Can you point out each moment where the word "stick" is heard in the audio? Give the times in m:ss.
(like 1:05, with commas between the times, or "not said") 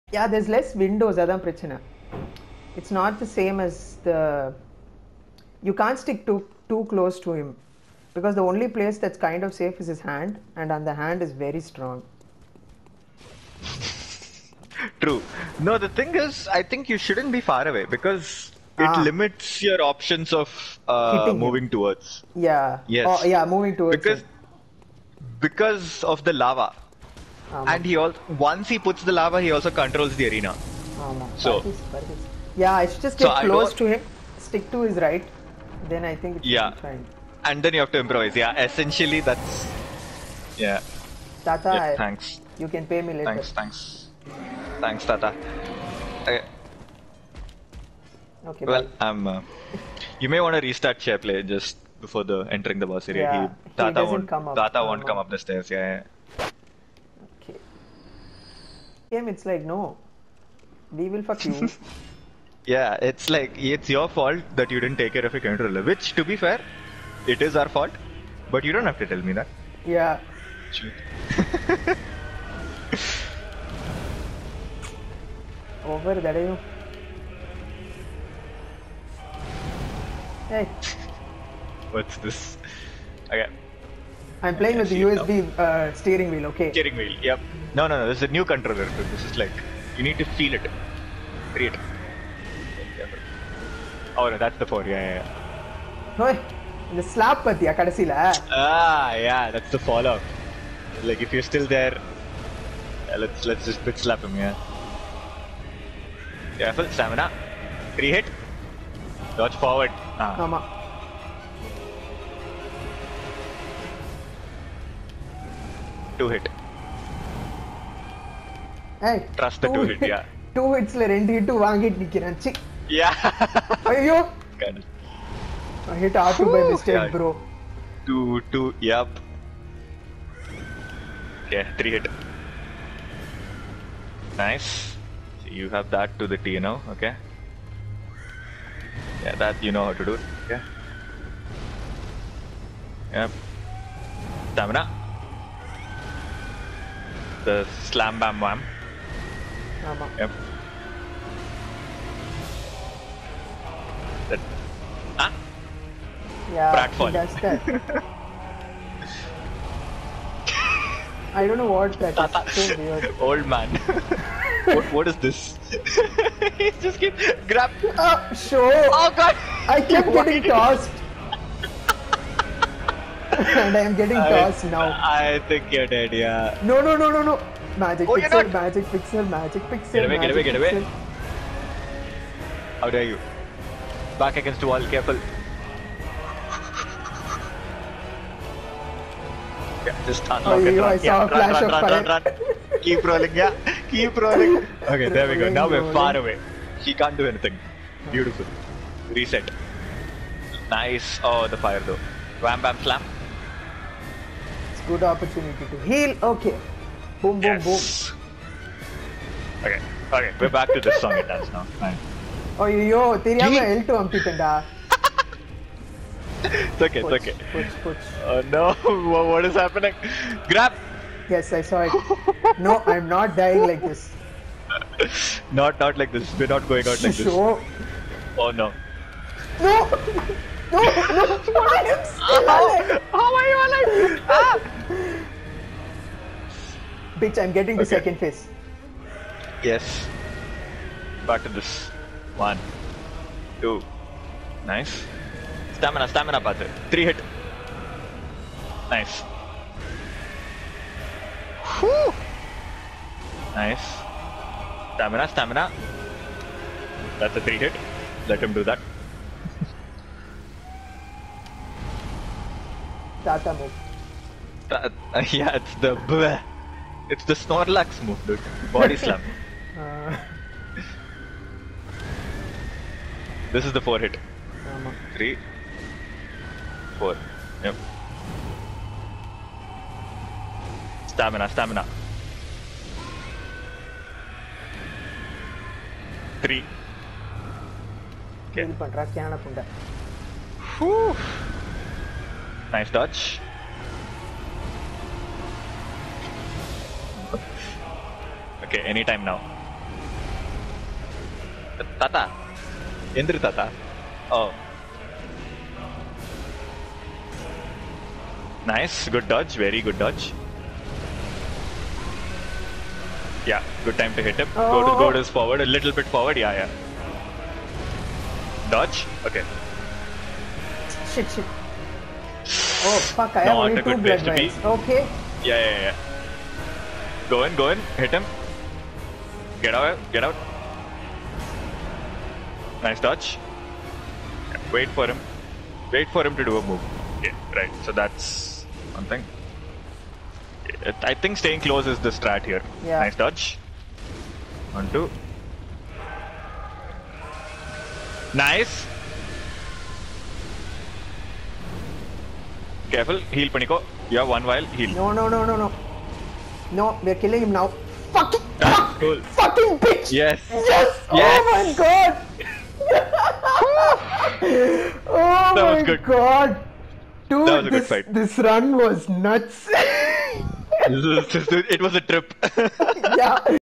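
0:06, 0:34.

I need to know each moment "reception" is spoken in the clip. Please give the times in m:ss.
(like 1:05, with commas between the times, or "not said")
not said.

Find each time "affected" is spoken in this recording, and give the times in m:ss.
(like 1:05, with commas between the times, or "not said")
not said.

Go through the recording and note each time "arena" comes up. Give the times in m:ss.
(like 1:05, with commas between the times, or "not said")
0:30.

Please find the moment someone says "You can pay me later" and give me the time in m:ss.
0:42.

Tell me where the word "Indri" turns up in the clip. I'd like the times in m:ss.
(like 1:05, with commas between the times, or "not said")
5:03.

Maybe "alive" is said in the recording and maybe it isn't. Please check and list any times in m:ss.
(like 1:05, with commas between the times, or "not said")
3:52.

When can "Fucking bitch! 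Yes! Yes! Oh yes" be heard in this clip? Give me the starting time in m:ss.
5:59.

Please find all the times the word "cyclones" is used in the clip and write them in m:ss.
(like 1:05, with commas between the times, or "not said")
not said.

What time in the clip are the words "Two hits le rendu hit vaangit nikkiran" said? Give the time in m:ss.
2:00.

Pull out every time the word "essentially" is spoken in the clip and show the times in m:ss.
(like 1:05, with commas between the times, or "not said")
0:38.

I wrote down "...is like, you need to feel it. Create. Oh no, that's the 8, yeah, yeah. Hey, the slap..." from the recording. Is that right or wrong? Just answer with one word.
wrong.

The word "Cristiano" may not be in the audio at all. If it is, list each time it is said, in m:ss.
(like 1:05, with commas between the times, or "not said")
not said.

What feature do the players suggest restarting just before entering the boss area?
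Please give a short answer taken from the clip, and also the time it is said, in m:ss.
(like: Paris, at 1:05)
Share Play, at 0:51.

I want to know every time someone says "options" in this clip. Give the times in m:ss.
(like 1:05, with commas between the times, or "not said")
0:19.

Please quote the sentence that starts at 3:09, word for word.
Yeah, just unlock oh, it, run.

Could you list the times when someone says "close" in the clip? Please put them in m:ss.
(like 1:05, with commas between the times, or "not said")
0:06, 0:33, 5:41.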